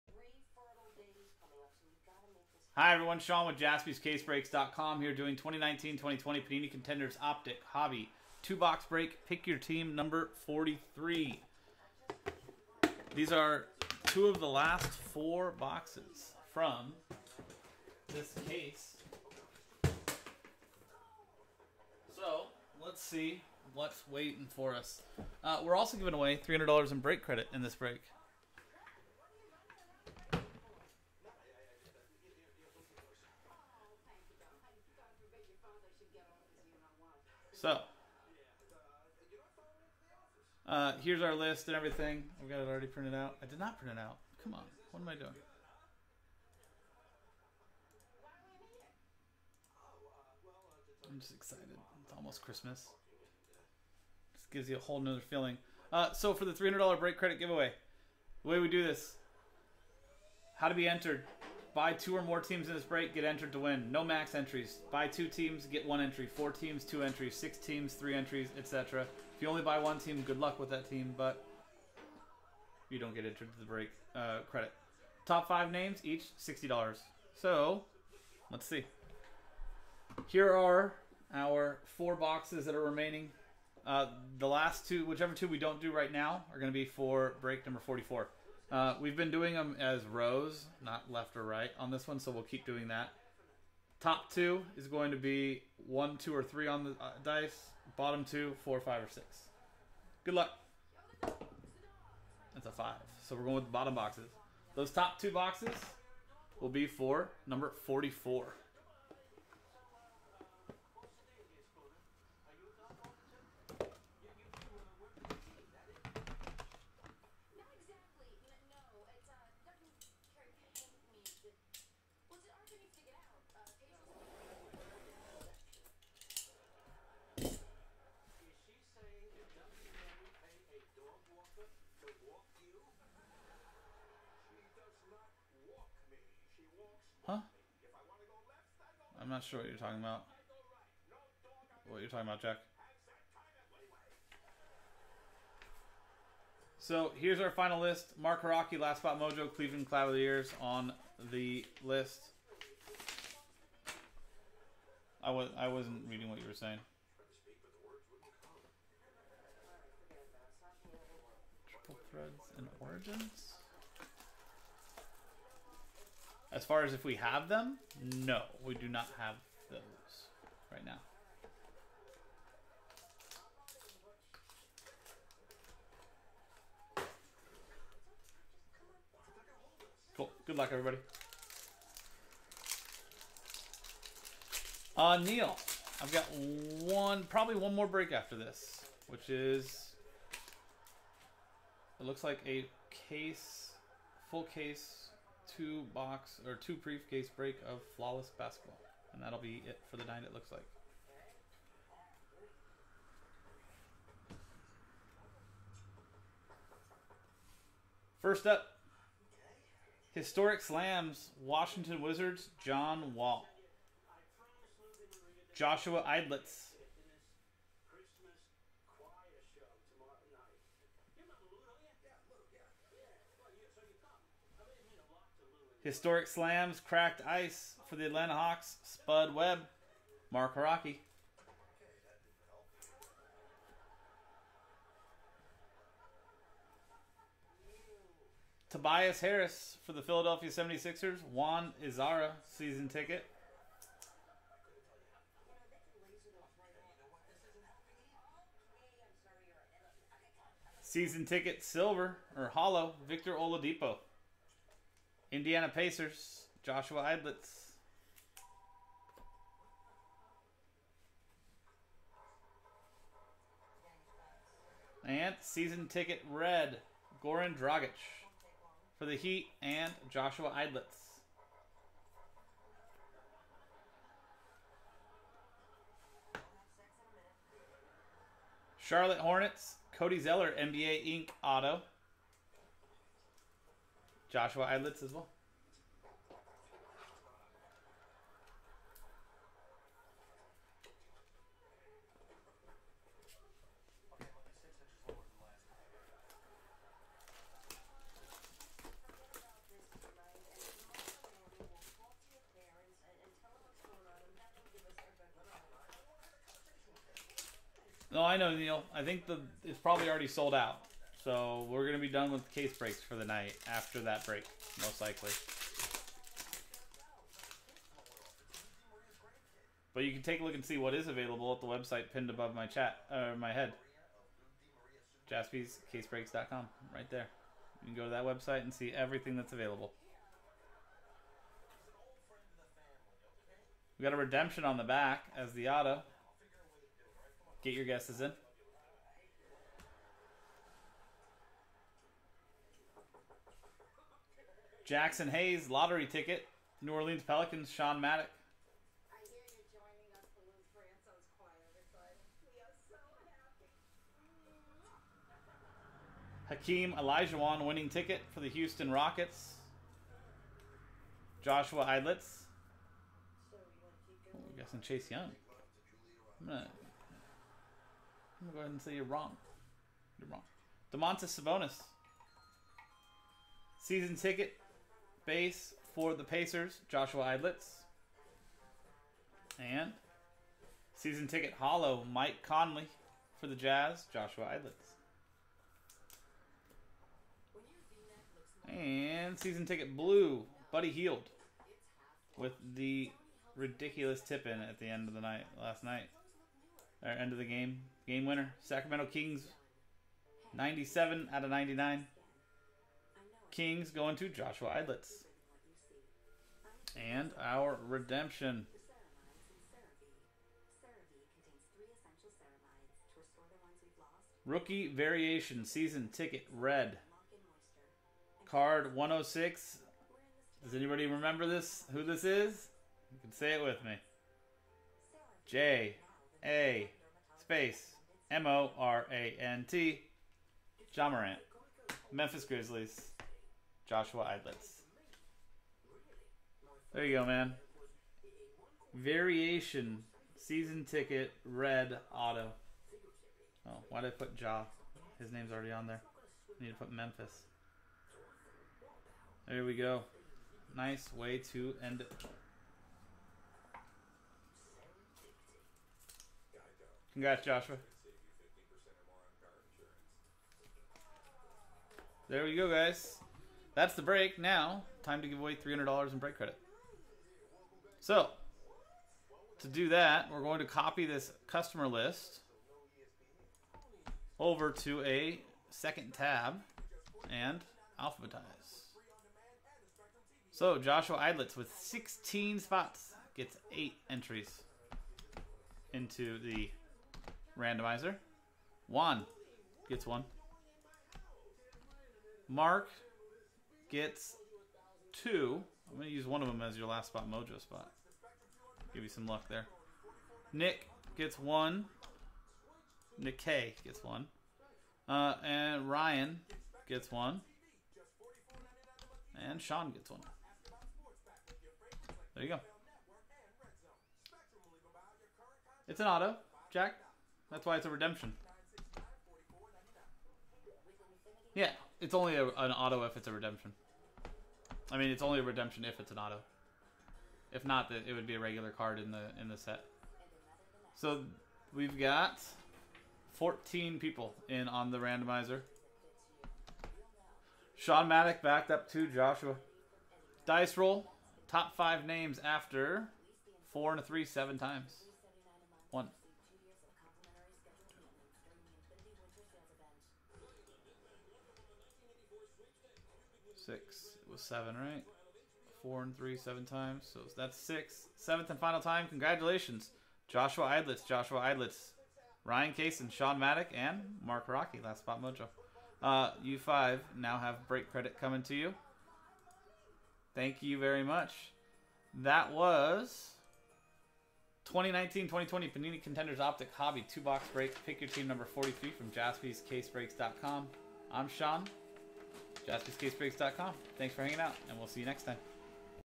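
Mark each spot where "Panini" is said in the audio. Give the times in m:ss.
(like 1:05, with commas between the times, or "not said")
0:06, 9:35.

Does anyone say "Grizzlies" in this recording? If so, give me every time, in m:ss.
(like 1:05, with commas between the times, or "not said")
7:12.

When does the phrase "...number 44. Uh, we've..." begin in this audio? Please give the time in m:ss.
1:27.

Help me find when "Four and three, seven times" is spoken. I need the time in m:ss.
9:15.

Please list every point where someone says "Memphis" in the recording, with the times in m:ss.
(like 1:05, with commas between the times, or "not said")
7:12, 7:26.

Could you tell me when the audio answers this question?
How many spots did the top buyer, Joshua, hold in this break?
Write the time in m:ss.
8:01.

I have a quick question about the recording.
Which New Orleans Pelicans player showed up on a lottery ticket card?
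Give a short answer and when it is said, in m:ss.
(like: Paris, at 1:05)
Jaxson Hayes, at 5:44.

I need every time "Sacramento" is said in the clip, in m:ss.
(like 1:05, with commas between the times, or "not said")
6:38.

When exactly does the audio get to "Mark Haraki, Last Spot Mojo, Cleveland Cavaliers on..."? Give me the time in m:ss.
2:28.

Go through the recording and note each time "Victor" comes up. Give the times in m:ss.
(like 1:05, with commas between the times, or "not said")
4:13.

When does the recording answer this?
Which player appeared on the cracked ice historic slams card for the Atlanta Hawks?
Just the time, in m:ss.
3:48.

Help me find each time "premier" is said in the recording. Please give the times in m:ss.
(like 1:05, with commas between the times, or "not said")
not said.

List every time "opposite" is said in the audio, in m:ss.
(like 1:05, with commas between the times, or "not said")
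not said.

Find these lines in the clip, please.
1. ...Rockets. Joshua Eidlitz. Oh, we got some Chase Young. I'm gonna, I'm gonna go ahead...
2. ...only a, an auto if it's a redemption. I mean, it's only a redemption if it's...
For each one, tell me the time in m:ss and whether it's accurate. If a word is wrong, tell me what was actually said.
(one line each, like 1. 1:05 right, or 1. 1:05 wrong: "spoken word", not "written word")
1. 5:58 right
2. 8:42 right.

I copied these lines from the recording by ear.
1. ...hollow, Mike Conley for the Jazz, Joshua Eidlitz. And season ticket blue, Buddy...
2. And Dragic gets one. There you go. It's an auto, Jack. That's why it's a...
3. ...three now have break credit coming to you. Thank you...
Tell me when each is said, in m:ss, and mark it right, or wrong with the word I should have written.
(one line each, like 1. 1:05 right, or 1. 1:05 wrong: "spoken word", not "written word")
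1. 6:21 right
2. 8:29 wrong: "Sean", not "Dragic"
3. 9:26 wrong: "five", not "three".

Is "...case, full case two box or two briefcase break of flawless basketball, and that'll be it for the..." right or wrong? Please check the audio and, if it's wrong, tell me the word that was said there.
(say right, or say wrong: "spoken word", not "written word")
right.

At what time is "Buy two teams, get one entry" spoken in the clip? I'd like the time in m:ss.
1:04.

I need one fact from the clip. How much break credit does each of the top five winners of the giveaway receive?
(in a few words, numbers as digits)
$60.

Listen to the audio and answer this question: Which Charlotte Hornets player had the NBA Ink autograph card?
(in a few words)
Cody Zeller.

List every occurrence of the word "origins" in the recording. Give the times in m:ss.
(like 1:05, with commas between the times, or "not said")
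2:42.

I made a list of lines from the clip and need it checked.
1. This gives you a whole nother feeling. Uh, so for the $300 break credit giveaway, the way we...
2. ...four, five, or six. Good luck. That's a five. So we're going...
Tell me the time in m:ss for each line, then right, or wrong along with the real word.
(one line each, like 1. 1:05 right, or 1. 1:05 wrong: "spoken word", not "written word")
1. 0:54 right
2. 1:38 right.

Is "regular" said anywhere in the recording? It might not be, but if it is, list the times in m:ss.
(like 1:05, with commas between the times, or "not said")
8:48.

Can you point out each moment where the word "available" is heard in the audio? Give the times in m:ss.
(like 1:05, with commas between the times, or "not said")
5:21, 5:29.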